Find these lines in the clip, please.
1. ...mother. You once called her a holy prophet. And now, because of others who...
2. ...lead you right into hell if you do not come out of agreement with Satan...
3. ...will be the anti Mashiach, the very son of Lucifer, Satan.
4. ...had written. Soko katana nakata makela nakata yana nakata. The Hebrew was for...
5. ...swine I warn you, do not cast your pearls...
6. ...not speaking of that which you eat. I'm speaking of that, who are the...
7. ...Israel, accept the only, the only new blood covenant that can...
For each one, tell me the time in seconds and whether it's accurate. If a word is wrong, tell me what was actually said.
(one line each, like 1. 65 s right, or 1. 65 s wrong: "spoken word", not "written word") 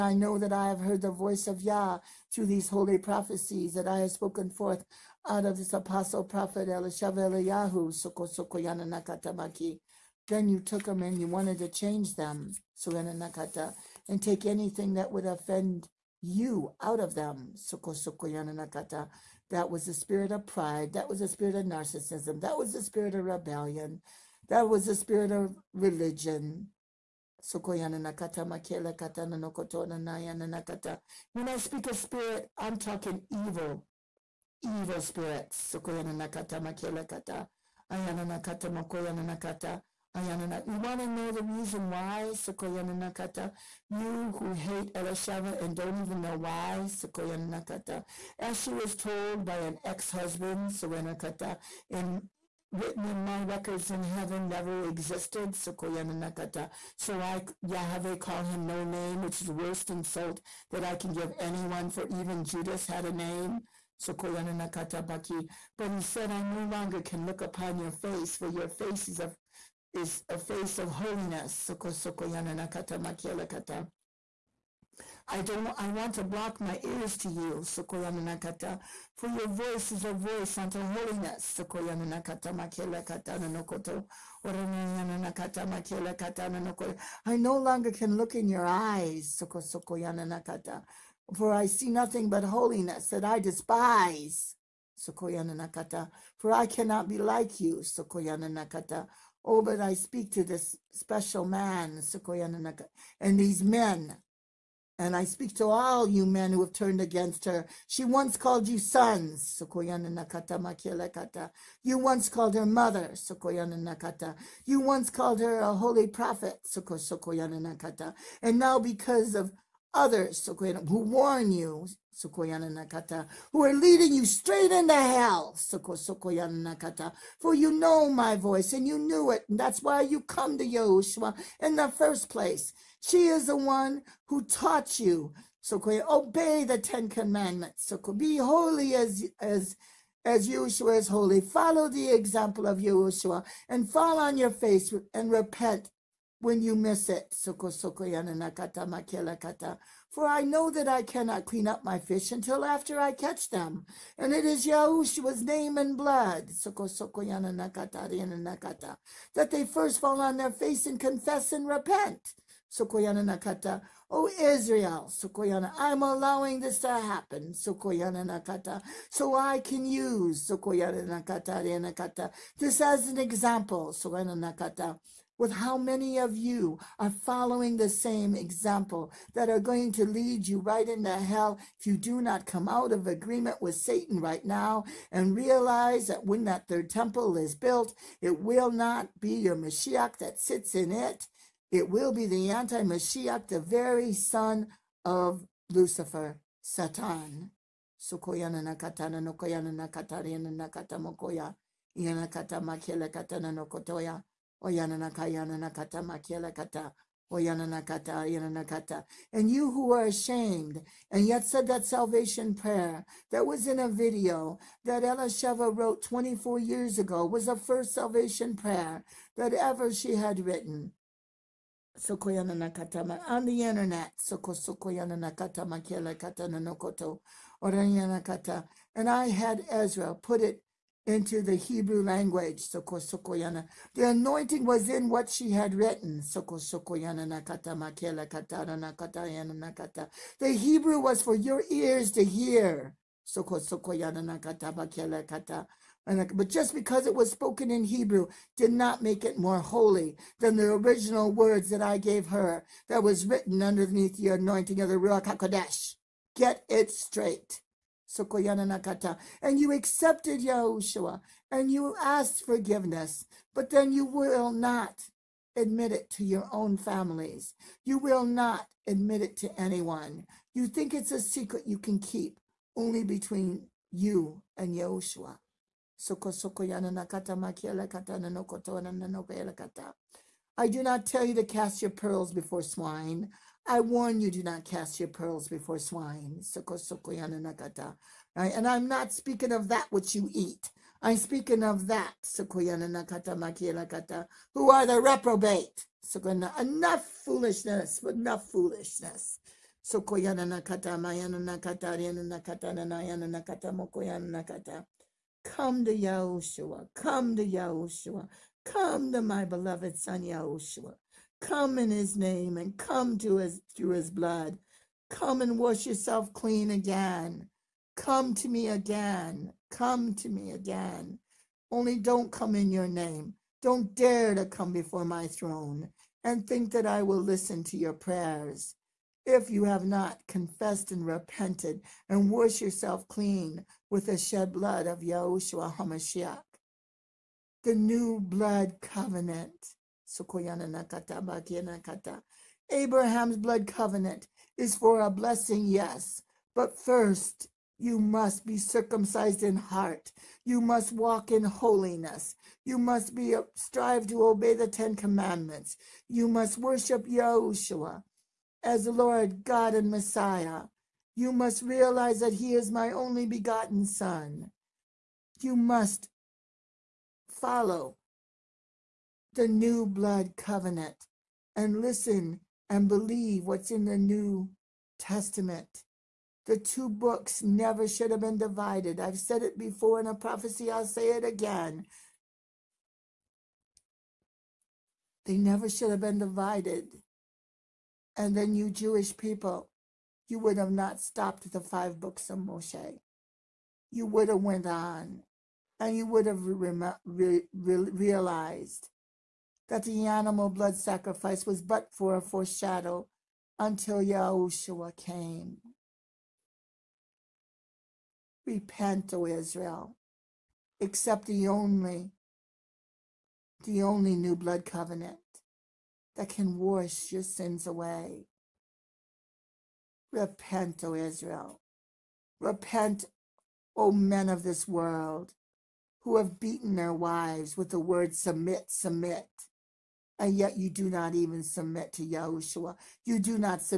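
1. 112 s right
2. 180 s right
3. 191 s right
4. 235 s wrong: "sokoyana", not "katana"
5. 282 s right
6. 288 s right
7. 409 s right.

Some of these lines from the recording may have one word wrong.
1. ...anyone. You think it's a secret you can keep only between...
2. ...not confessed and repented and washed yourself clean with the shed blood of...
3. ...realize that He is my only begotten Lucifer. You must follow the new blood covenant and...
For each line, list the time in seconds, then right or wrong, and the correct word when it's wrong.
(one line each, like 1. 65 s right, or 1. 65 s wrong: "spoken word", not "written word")
1. 269 s right
2. 329 s right
3. 361 s wrong: "Son", not "Lucifer".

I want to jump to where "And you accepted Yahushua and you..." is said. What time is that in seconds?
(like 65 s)
258 s.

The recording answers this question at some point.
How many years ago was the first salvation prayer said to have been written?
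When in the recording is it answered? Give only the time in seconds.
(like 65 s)
216 s.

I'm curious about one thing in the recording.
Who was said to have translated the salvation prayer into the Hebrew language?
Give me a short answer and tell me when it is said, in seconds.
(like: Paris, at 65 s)
Ezra, at 229 s.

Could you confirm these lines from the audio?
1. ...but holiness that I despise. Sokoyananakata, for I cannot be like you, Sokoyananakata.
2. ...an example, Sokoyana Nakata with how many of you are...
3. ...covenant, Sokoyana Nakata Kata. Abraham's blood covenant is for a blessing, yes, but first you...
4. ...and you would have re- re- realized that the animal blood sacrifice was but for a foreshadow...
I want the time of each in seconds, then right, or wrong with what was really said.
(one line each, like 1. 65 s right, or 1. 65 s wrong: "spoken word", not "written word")
1. 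92 s right
2. 173 s right
3. 338 s right
4. 395 s right.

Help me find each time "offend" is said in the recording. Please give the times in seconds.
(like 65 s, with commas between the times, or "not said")
15 s.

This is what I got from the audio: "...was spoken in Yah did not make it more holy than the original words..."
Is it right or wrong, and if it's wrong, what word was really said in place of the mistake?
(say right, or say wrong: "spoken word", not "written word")
wrong: "Hebrew", not "Yah".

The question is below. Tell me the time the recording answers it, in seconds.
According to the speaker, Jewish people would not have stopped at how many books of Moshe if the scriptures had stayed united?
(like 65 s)
391 s.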